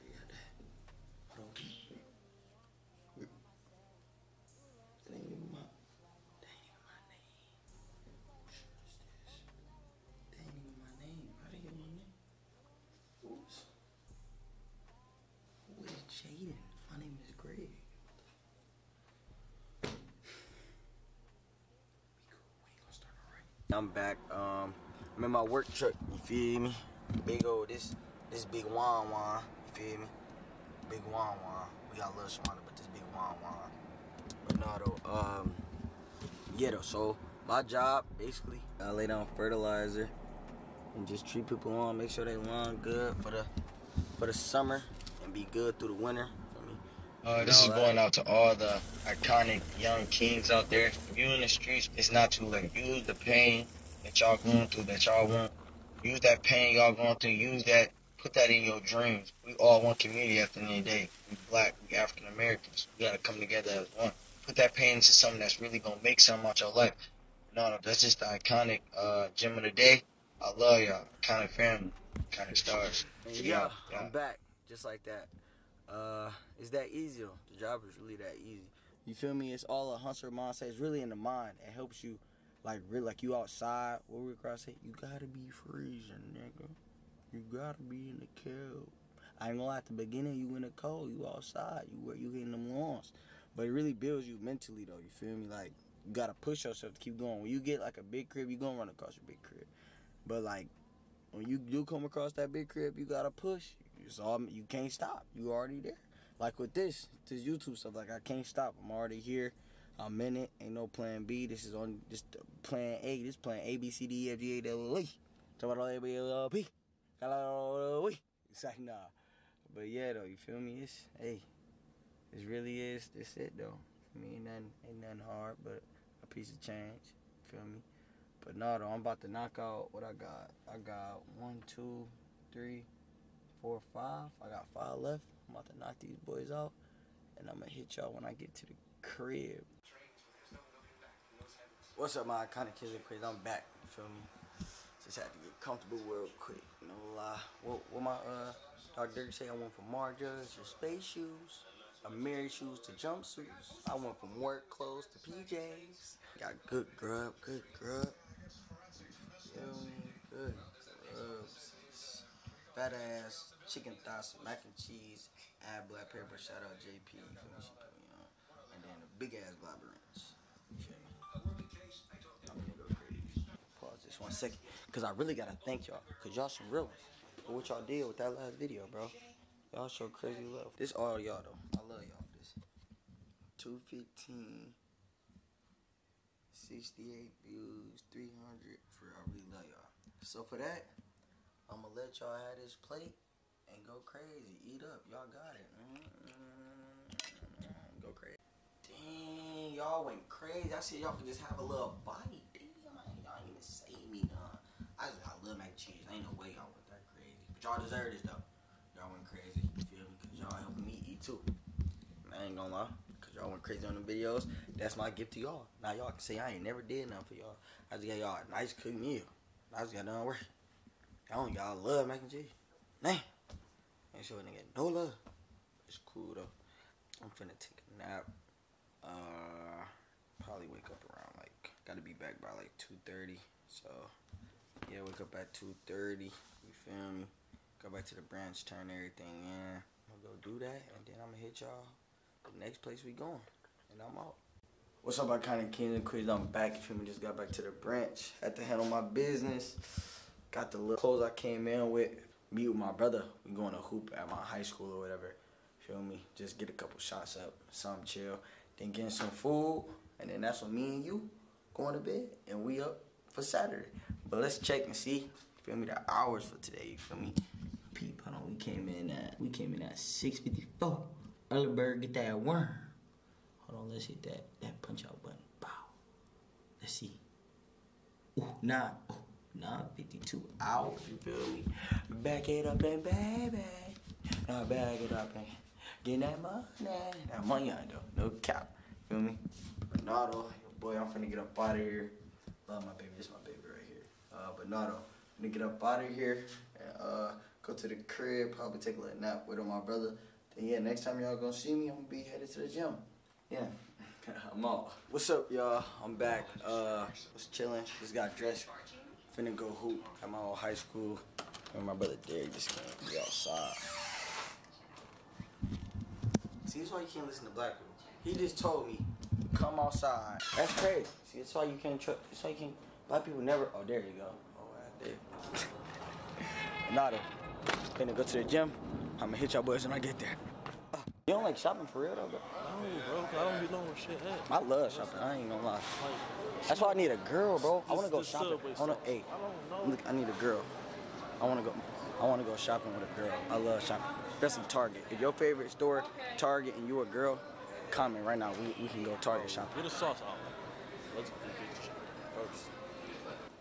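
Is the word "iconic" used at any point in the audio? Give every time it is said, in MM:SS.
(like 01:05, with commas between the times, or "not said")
00:49, 01:08, 02:22.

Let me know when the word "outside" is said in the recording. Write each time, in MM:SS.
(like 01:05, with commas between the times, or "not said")
01:23, 01:31, 05:13, 05:19.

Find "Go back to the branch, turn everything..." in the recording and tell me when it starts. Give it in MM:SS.
03:57.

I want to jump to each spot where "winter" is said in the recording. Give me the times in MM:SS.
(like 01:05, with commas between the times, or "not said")
00:45.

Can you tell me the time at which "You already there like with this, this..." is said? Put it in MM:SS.
01:45.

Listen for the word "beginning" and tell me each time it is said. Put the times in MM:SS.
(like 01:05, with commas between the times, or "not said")
01:29.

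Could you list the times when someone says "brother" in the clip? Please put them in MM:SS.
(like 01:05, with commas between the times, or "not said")
04:12, 04:59, 05:11.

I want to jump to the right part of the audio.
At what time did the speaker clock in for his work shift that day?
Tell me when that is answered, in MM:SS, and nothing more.
04:29.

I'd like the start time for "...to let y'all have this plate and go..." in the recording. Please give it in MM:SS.
03:11.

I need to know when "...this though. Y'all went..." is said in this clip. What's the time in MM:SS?
03:28.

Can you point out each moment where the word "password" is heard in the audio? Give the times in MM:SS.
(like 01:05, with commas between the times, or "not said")
not said.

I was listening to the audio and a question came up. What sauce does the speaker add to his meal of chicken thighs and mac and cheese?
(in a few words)
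Ranch.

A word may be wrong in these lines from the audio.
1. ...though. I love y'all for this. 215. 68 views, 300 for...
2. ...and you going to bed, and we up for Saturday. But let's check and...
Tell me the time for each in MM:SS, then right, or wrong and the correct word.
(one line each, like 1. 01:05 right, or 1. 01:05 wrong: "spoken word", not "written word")
1. 03:01 right
2. 04:20 right.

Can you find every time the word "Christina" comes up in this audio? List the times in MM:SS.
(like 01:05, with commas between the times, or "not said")
not said.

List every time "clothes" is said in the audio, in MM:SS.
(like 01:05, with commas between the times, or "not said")
02:34, 04:10.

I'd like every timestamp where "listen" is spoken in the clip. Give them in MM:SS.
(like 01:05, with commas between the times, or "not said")
05:17.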